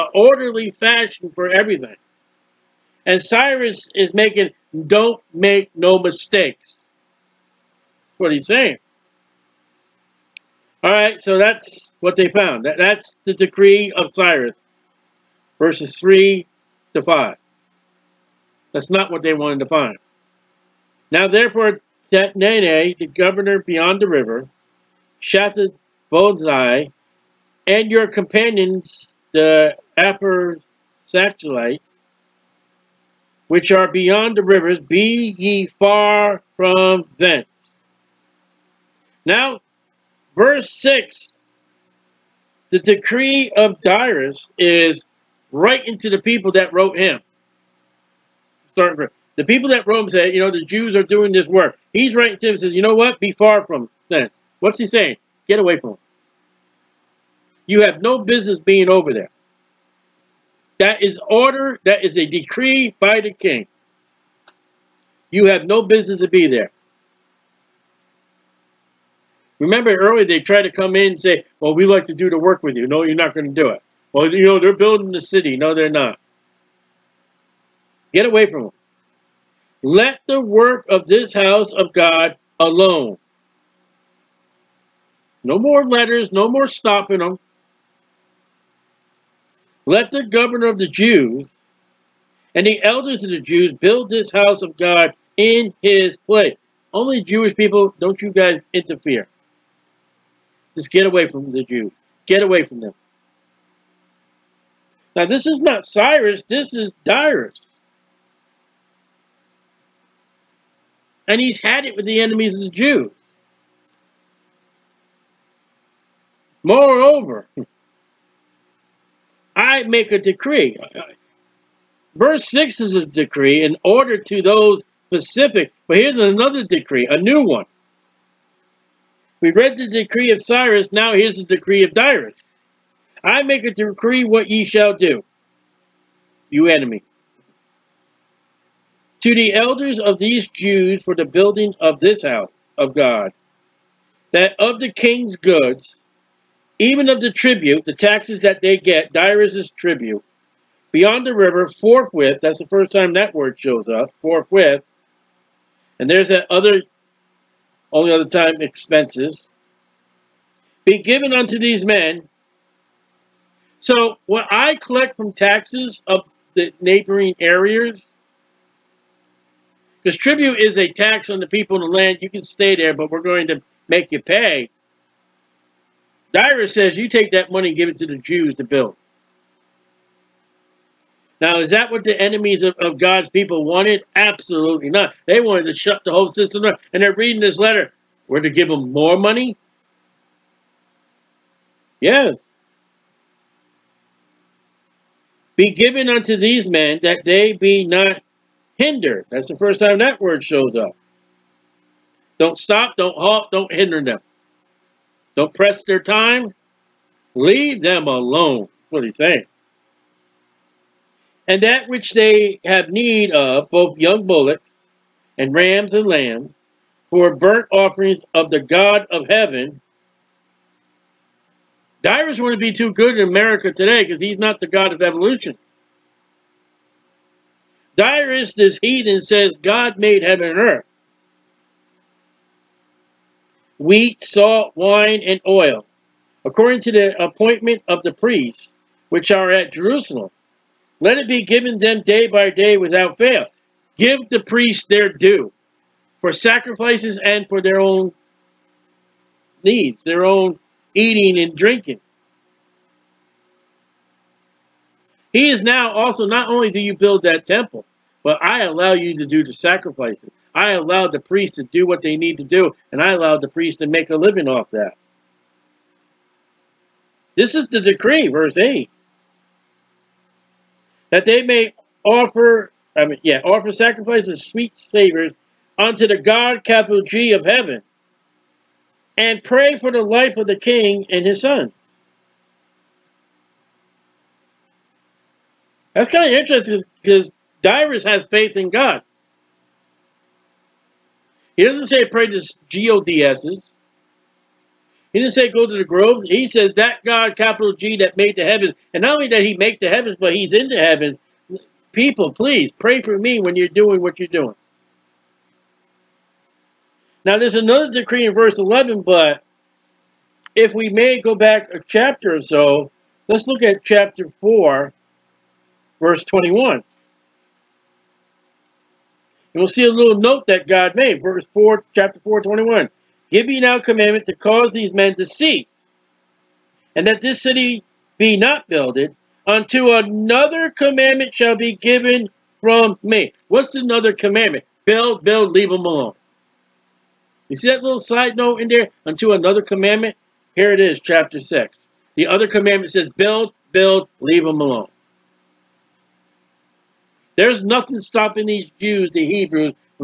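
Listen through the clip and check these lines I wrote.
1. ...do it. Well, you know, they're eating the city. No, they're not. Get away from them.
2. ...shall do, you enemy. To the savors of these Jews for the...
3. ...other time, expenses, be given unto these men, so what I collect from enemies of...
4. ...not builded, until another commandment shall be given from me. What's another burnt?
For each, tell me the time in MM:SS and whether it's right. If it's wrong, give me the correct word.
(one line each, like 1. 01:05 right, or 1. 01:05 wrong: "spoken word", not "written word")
1. 01:13 wrong: "building", not "eating"
2. 02:14 wrong: "elders", not "savors"
3. 02:38 wrong: "taxes", not "enemies"
4. 05:28 wrong: "commandment", not "burnt".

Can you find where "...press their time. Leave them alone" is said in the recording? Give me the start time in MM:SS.
03:25.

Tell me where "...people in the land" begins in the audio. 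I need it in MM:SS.
02:51.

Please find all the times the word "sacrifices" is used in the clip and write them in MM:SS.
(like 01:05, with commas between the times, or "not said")
04:06, 04:19, 04:33.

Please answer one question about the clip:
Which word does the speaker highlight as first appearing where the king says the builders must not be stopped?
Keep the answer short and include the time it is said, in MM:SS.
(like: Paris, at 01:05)
Hindered, at 03:18.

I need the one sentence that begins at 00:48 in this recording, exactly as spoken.
Starting the people that Rome said, you know, the Jews are doing this work.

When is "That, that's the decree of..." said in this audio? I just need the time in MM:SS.
00:12.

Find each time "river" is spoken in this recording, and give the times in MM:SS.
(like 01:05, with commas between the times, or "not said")
00:24, 00:34, 02:31.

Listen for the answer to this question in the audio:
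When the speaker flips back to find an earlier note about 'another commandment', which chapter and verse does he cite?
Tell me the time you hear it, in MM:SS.
05:13.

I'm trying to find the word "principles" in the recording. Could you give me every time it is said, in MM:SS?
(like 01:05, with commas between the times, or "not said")
not said.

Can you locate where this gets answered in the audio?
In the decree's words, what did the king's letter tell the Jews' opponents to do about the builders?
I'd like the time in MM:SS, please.
00:34.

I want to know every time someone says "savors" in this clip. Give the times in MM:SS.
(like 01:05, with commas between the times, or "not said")
04:34.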